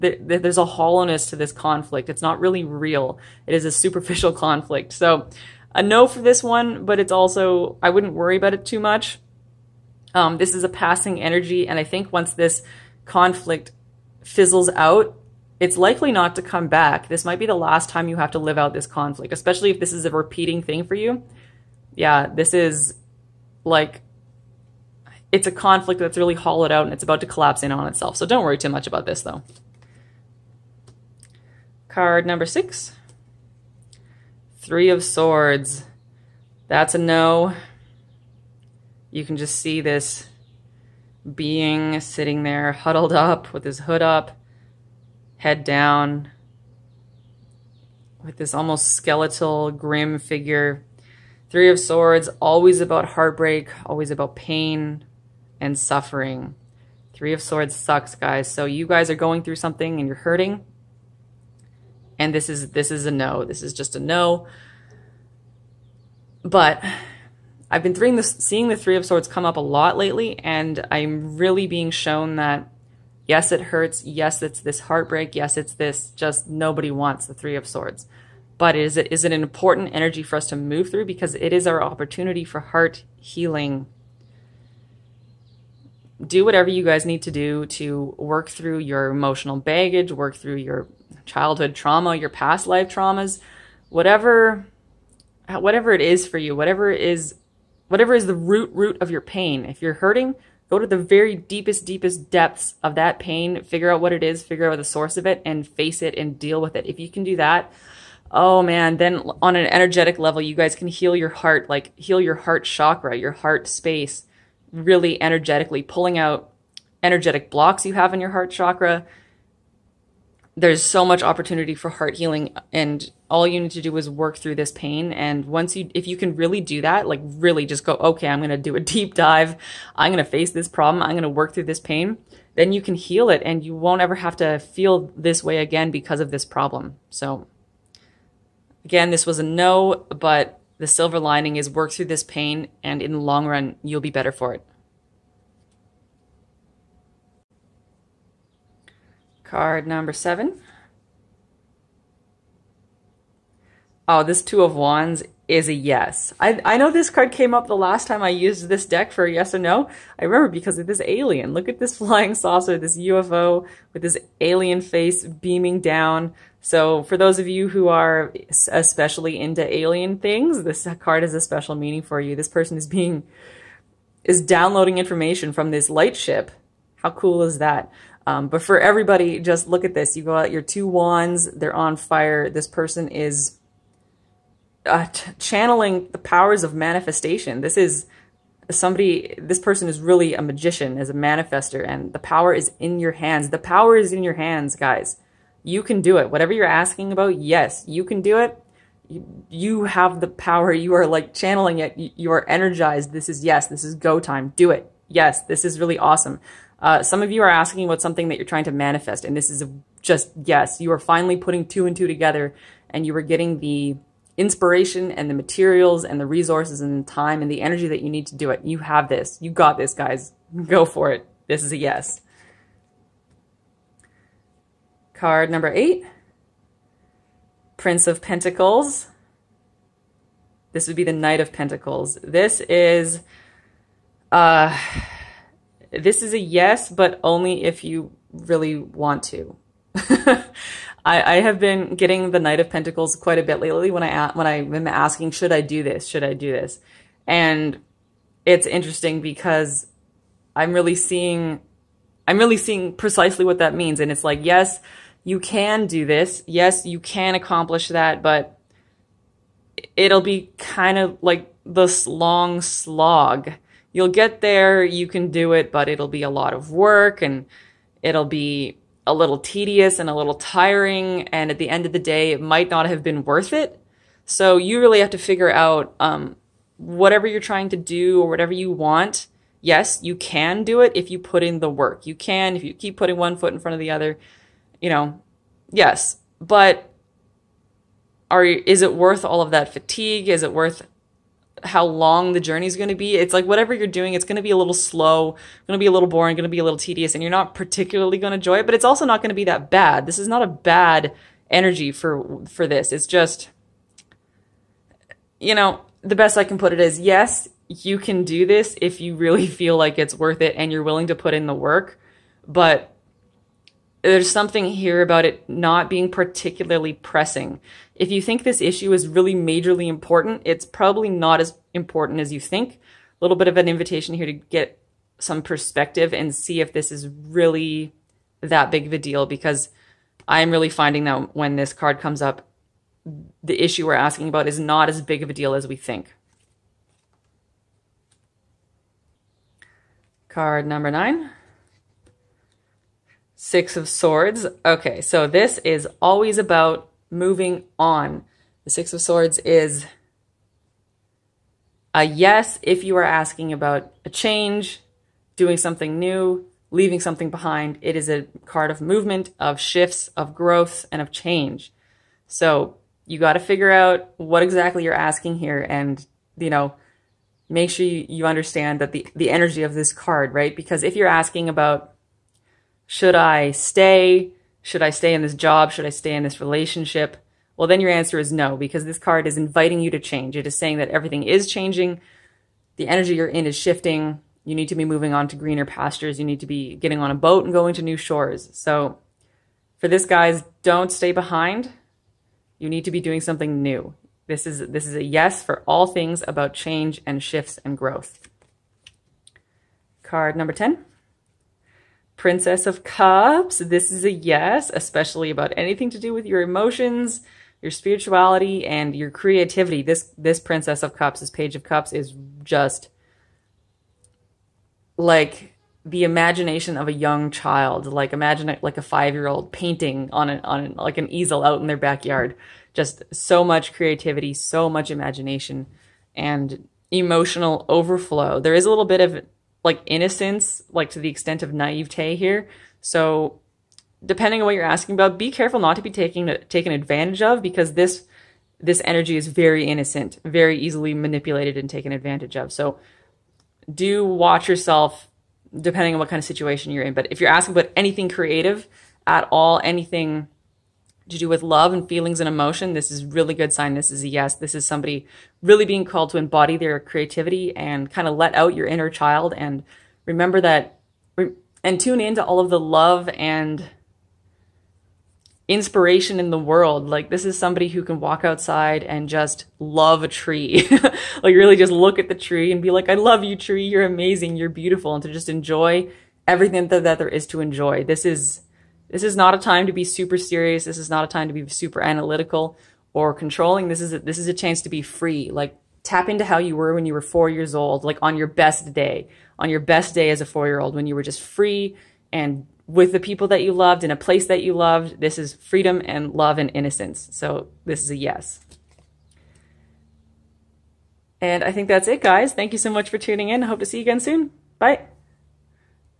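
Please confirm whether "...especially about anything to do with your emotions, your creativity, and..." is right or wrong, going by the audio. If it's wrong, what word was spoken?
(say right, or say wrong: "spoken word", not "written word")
wrong: "spirituality", not "creativity".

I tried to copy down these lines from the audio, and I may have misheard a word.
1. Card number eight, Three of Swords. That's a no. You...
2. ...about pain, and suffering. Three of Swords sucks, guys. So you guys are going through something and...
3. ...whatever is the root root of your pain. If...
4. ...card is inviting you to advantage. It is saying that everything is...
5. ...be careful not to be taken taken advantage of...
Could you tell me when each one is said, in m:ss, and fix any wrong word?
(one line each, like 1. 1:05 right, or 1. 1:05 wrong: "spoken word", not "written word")
1. 0:31 wrong: "six", not "eight"
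2. 0:54 right
3. 1:37 right
4. 6:18 wrong: "change", not "advantage"
5. 7:15 right.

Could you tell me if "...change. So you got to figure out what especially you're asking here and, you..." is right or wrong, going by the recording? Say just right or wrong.
wrong.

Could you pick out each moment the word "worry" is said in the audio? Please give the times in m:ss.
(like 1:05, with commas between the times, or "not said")
0:08, 0:28.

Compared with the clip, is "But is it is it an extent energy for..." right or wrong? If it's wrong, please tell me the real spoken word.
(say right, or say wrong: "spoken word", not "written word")
wrong: "important", not "extent".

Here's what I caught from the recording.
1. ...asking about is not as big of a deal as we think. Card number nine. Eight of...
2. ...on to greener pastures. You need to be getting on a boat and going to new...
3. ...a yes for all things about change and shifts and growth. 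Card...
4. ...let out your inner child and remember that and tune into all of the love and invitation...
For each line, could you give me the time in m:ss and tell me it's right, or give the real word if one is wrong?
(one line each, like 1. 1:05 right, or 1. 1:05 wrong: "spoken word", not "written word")
1. 5:33 wrong: "Six", not "Eight"
2. 6:25 right
3. 6:34 right
4. 7:38 wrong: "inspiration", not "invitation".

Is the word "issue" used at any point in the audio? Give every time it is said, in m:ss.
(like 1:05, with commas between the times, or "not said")
5:18, 5:33.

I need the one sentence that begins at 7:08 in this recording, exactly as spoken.
There is a little bit of like innocence, like to the extent of naivete here.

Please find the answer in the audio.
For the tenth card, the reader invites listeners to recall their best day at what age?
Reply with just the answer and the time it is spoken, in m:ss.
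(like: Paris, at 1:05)
4, at 8:07.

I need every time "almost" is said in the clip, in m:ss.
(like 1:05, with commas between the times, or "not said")
0:48.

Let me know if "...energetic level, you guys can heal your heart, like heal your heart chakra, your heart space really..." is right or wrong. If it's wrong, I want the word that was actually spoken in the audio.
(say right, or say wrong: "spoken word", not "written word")
right.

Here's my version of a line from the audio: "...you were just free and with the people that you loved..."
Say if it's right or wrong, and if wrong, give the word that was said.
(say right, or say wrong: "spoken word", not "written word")
right.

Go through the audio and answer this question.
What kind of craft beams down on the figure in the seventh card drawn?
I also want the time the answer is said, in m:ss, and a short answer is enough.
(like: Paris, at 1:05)
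flying saucer, at 2:41.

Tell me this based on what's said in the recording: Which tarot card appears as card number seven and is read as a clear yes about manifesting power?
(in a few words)
Two of Wands.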